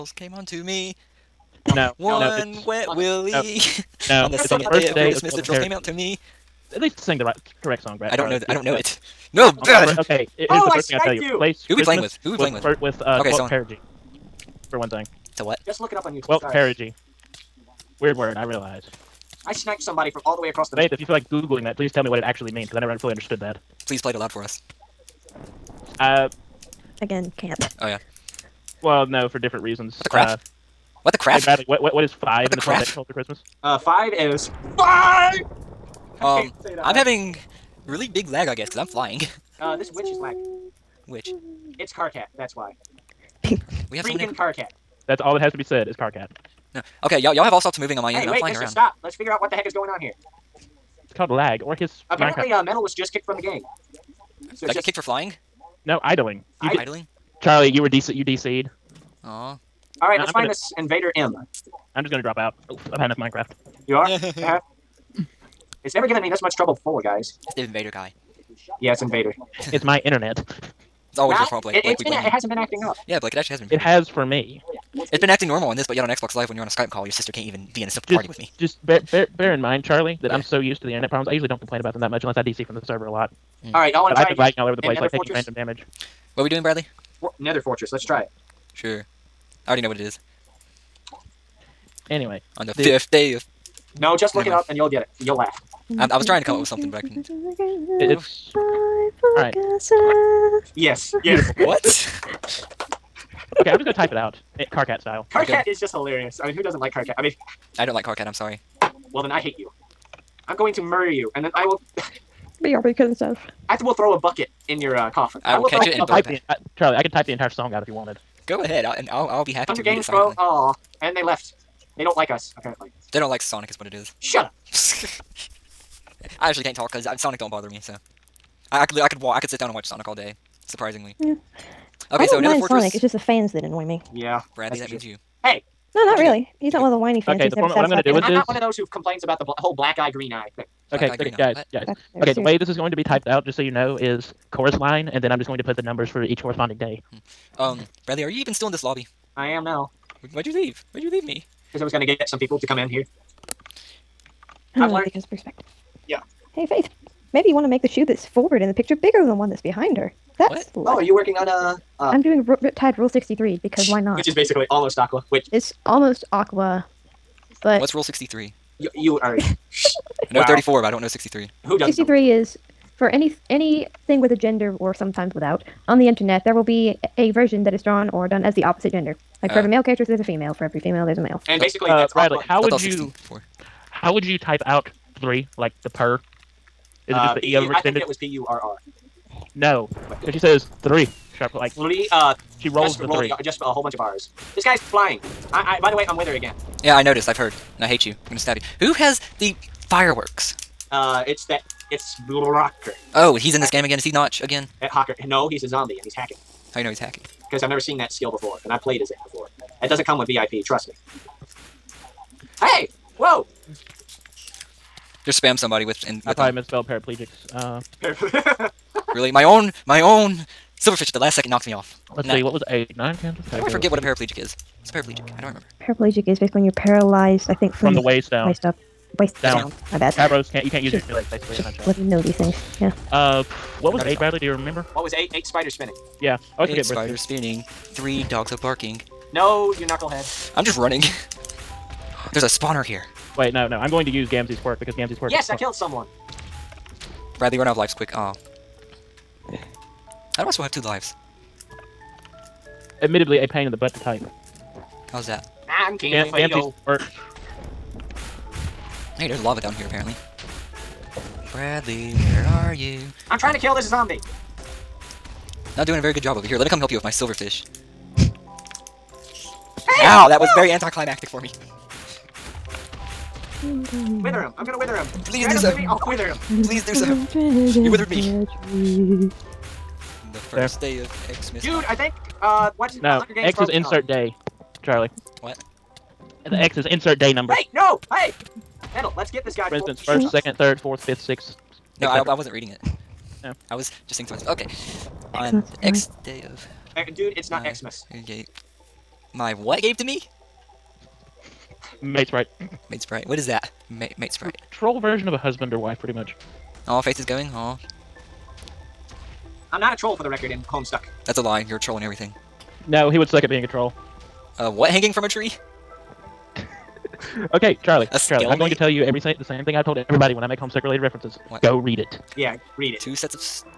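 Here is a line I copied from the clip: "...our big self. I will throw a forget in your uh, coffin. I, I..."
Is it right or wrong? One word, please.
wrong.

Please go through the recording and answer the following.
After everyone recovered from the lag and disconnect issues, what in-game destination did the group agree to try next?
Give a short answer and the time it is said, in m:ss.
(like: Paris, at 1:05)
Nether Fortress, at 1:27.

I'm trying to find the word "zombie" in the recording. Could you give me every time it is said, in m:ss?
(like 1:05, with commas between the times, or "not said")
3:25, 4:23.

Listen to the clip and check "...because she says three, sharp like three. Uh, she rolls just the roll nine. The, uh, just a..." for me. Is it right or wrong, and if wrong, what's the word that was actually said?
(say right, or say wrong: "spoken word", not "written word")
wrong: "three", not "nine".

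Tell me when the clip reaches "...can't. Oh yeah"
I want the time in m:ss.
0:27.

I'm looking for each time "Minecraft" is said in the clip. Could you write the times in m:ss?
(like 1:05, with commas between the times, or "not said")
1:03.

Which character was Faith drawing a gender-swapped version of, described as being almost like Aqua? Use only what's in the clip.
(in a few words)
Riptide.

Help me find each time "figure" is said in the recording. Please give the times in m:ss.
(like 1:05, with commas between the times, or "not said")
0:49.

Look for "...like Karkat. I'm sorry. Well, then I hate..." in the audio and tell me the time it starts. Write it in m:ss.
1:47.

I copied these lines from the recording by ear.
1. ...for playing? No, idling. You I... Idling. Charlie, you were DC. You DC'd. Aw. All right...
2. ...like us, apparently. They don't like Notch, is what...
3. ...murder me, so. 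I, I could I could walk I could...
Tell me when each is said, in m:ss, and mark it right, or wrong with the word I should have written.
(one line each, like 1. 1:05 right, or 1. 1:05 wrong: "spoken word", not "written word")
1. 0:54 wrong: "flying", not "playing"
2. 2:02 wrong: "Sonic", not "Notch"
3. 2:07 wrong: "bother", not "murder".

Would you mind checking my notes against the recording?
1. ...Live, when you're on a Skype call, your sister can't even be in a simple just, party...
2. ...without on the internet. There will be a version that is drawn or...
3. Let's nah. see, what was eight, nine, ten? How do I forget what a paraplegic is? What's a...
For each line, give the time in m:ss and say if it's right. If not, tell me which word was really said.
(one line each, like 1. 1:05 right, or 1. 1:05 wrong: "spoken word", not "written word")
1. 1:16 right
2. 2:55 right
3. 3:42 right.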